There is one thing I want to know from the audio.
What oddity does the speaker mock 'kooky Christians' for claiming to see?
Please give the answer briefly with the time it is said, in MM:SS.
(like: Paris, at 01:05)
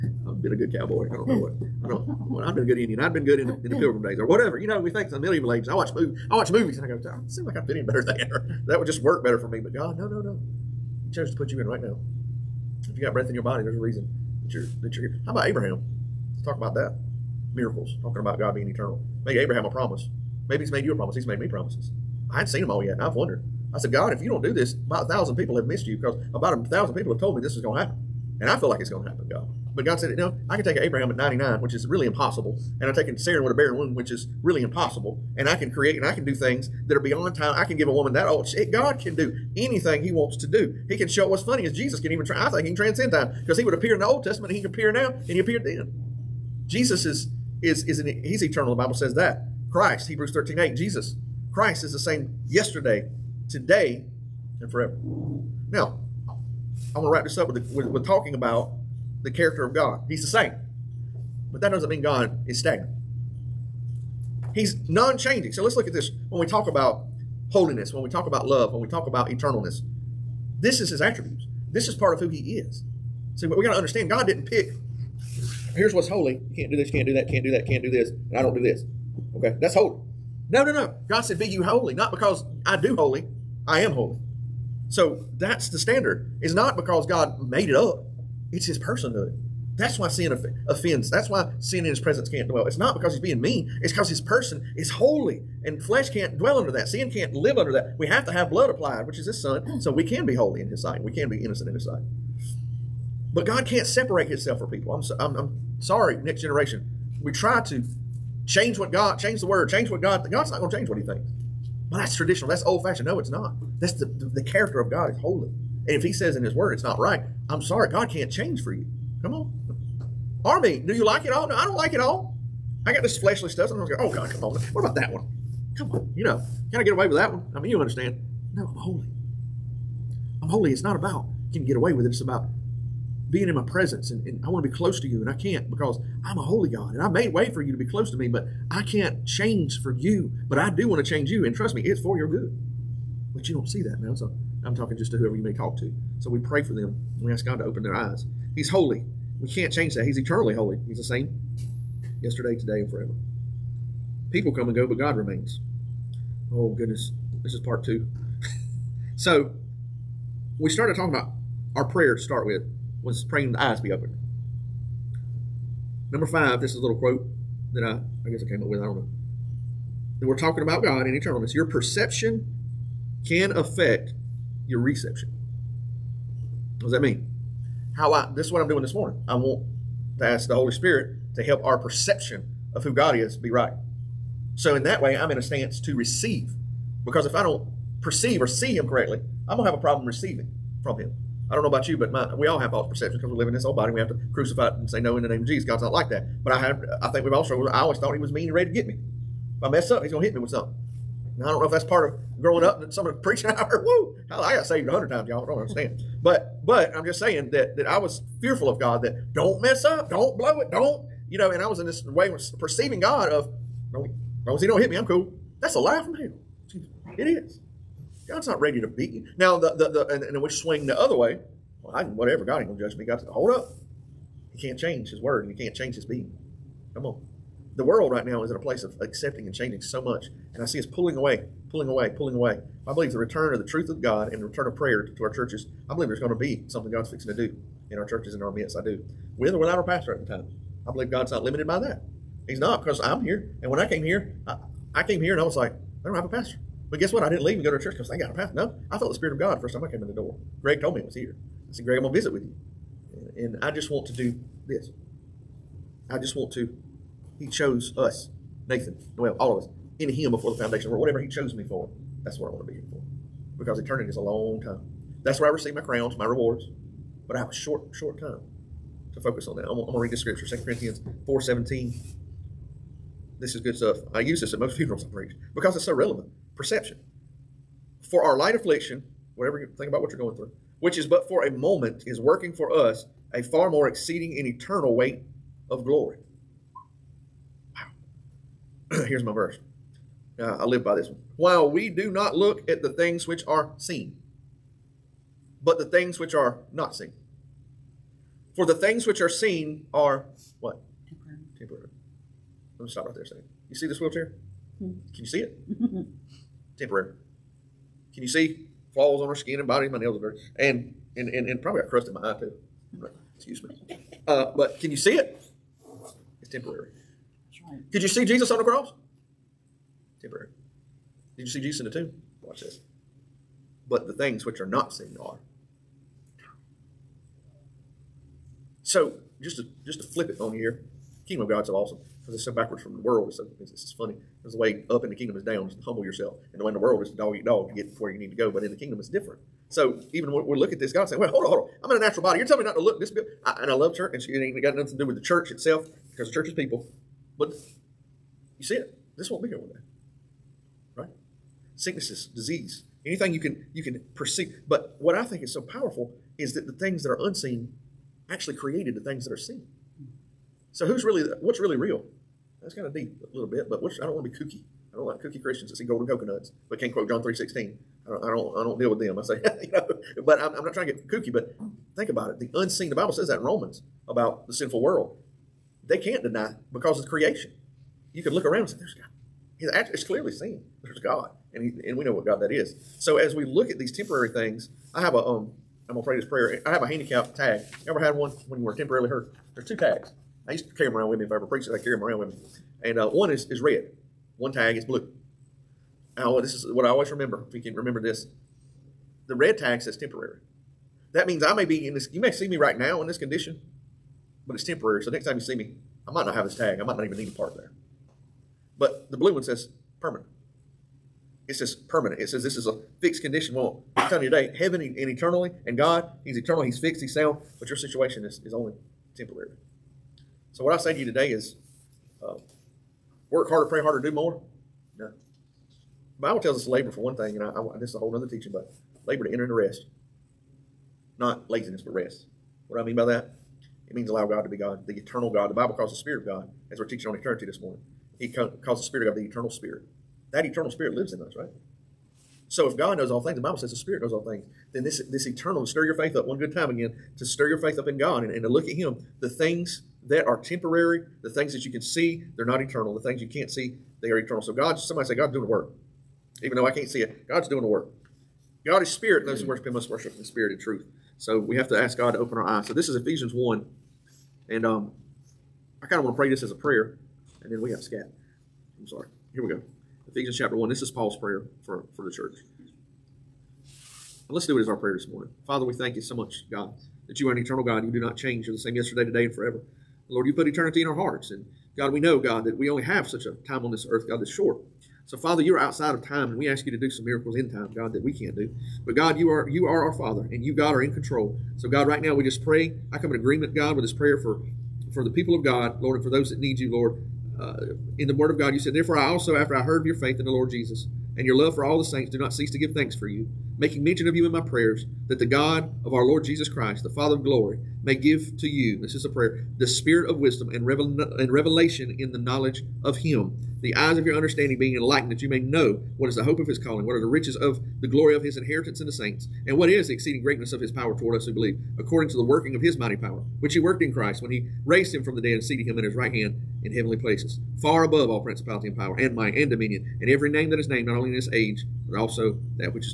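golden coconuts, at 06:05.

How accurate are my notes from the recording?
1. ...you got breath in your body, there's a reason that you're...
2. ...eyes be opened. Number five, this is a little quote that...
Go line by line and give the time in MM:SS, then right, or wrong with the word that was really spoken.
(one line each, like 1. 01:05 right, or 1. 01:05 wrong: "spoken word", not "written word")
1. 00:12 right
2. 02:43 right.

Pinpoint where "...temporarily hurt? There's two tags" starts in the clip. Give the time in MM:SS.
06:28.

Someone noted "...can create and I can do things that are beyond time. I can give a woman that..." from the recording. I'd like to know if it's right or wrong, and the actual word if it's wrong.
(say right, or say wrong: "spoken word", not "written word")
right.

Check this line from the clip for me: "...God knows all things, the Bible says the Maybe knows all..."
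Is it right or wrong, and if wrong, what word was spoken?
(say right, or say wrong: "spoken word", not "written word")
wrong: "Spirit", not "Maybe".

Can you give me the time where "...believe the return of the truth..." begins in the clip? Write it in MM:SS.
03:52.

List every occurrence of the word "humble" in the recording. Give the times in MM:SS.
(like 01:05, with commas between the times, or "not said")
05:35.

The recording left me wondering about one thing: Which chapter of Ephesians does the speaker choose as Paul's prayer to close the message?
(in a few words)
Ephesians 1.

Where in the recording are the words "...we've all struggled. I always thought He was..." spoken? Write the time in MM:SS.
03:17.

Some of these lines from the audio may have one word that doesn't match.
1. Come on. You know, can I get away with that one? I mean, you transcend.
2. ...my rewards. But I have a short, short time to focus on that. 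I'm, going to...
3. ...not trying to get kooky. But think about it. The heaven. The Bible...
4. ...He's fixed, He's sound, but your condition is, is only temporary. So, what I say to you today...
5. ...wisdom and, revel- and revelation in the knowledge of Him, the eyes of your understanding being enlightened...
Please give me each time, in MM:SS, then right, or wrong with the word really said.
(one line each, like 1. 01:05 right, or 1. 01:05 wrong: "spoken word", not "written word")
1. 02:05 wrong: "understand", not "transcend"
2. 04:26 right
3. 06:10 wrong: "unseen", not "heaven"
4. 06:56 wrong: "situation", not "condition"
5. 08:30 right.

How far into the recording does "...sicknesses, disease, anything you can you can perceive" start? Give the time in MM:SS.
05:51.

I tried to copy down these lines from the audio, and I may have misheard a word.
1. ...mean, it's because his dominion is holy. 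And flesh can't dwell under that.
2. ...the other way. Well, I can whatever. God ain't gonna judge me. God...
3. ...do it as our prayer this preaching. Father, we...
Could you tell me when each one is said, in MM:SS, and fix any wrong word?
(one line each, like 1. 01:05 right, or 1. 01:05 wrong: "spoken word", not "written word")
1. 01:33 wrong: "person", not "dominion"
2. 03:40 right
3. 07:54 wrong: "morning", not "preaching".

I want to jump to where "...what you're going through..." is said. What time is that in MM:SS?
04:40.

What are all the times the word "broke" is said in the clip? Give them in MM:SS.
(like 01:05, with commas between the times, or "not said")
not said.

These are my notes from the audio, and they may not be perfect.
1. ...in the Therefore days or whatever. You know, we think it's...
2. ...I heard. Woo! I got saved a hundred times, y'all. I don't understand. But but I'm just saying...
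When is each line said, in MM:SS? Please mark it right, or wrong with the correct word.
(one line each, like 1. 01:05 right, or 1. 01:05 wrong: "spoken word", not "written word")
1. 00:03 wrong: "Pilgrim", not "Therefore"
2. 03:23 right.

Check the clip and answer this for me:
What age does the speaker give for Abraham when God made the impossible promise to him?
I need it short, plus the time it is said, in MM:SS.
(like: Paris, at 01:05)
99, at 00:31.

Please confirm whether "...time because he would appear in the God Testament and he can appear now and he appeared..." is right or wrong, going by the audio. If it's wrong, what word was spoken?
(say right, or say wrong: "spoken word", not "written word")
wrong: "Old", not "God".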